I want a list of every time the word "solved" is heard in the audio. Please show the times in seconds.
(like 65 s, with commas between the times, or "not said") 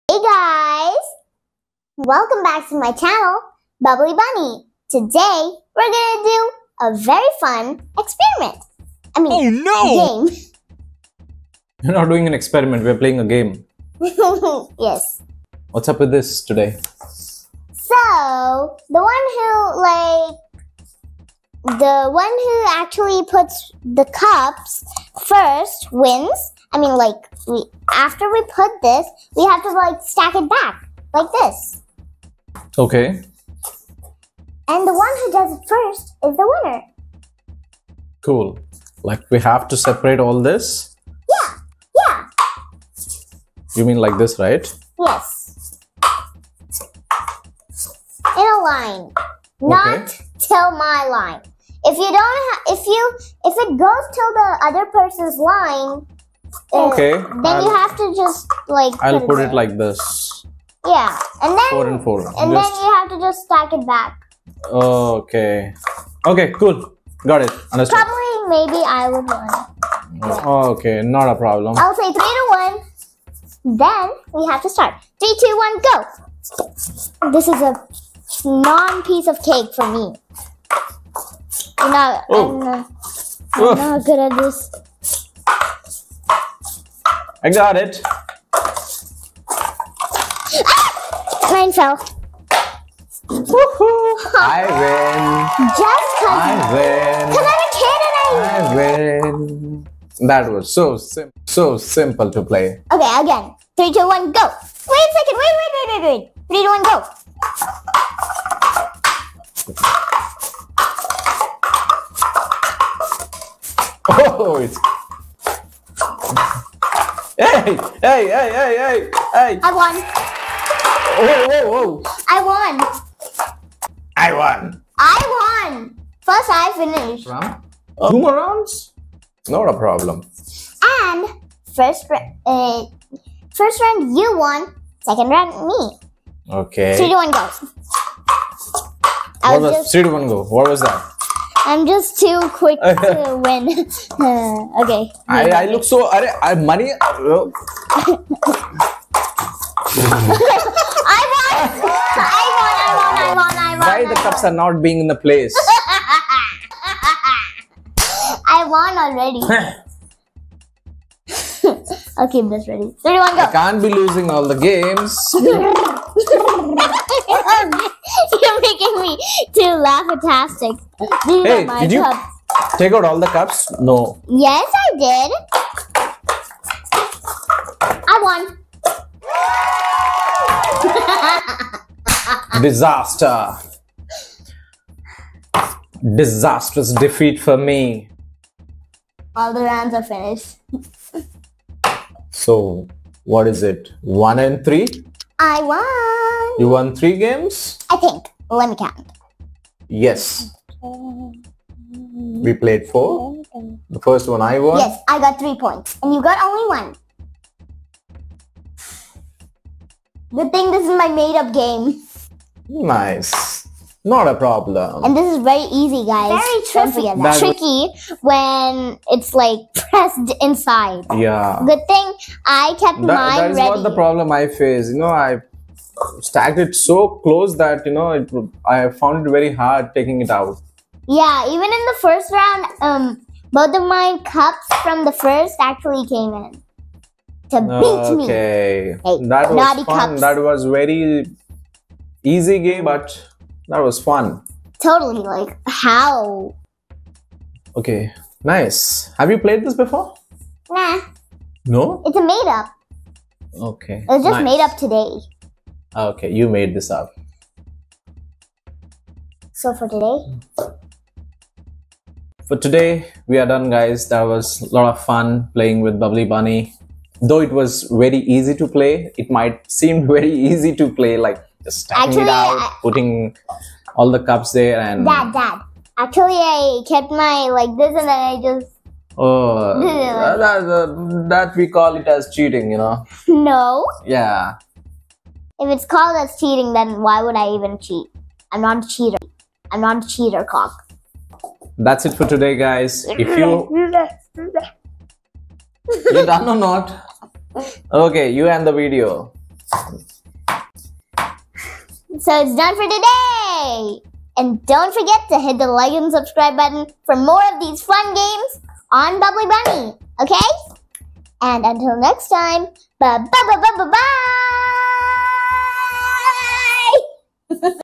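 not said.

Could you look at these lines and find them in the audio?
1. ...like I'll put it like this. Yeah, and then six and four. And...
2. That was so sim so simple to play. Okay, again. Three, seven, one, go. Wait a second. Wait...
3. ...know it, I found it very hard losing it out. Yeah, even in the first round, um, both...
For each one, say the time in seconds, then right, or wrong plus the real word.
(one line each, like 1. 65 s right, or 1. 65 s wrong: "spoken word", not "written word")
1. 58 s wrong: "four", not "six"
2. 100 s wrong: "two", not "seven"
3. 227 s wrong: "taking", not "losing".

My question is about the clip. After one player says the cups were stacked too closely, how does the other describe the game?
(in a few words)
Very tricky.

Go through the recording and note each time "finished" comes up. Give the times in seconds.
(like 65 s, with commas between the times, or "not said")
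126 s, 190 s.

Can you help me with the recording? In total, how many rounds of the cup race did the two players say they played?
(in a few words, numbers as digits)
4.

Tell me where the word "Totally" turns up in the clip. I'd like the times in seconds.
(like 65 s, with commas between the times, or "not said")
244 s.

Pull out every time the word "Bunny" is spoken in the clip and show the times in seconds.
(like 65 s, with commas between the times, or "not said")
4 s, 266 s, 309 s.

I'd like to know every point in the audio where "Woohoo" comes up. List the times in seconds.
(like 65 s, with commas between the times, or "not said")
93 s.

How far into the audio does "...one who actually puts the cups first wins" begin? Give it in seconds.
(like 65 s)
22 s.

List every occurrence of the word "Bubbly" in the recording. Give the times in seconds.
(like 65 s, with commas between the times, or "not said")
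3 s, 265 s, 309 s.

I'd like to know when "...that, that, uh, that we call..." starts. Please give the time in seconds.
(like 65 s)
279 s.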